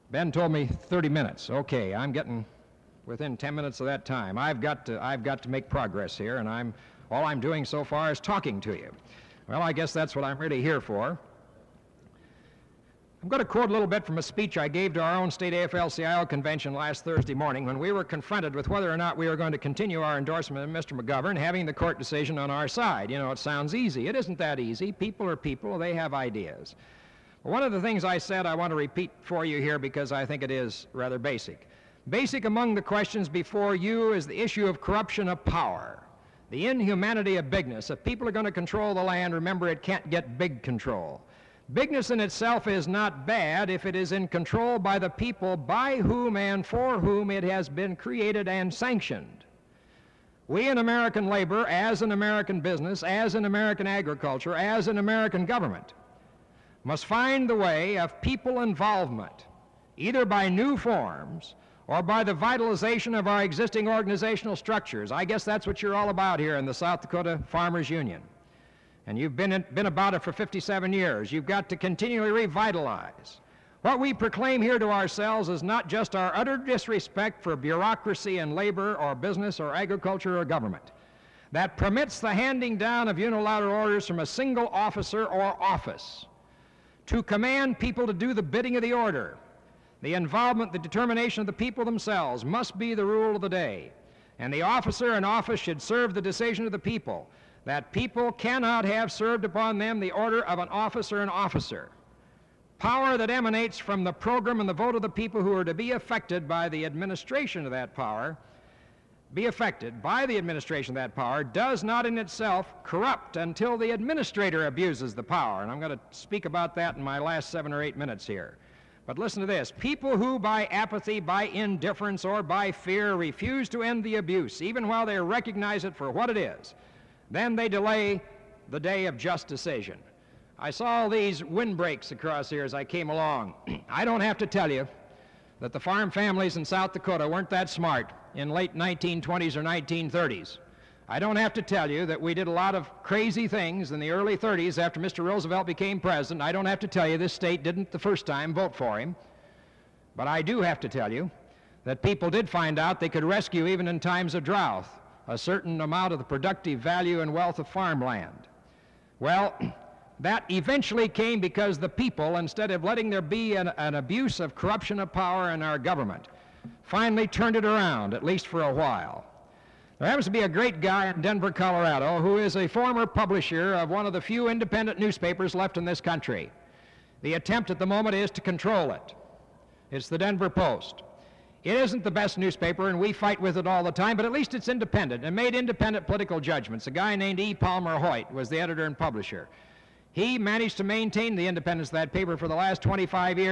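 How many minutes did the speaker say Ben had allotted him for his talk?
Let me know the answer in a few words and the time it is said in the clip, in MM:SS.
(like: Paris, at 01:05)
30, at 00:00.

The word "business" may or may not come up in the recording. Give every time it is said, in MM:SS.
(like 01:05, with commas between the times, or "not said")
00:52, 01:19.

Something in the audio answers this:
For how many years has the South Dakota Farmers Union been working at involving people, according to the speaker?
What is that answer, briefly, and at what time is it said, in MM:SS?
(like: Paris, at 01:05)
57, at 01:10.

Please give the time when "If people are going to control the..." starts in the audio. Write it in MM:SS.
00:37.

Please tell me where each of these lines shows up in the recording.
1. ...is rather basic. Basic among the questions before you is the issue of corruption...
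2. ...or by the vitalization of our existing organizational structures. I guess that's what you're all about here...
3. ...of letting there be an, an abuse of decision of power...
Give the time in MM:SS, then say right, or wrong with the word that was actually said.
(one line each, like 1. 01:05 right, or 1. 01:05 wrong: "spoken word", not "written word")
1. 00:30 right
2. 01:01 right
3. 02:42 wrong: "corruption", not "decision".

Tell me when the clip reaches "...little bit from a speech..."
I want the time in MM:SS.
00:13.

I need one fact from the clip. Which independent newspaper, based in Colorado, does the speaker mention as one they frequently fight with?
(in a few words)
Denver Post.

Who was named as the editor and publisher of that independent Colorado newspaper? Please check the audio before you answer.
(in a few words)
E. Palmer Hoyt.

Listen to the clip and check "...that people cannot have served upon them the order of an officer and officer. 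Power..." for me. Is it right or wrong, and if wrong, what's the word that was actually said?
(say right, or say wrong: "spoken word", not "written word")
right.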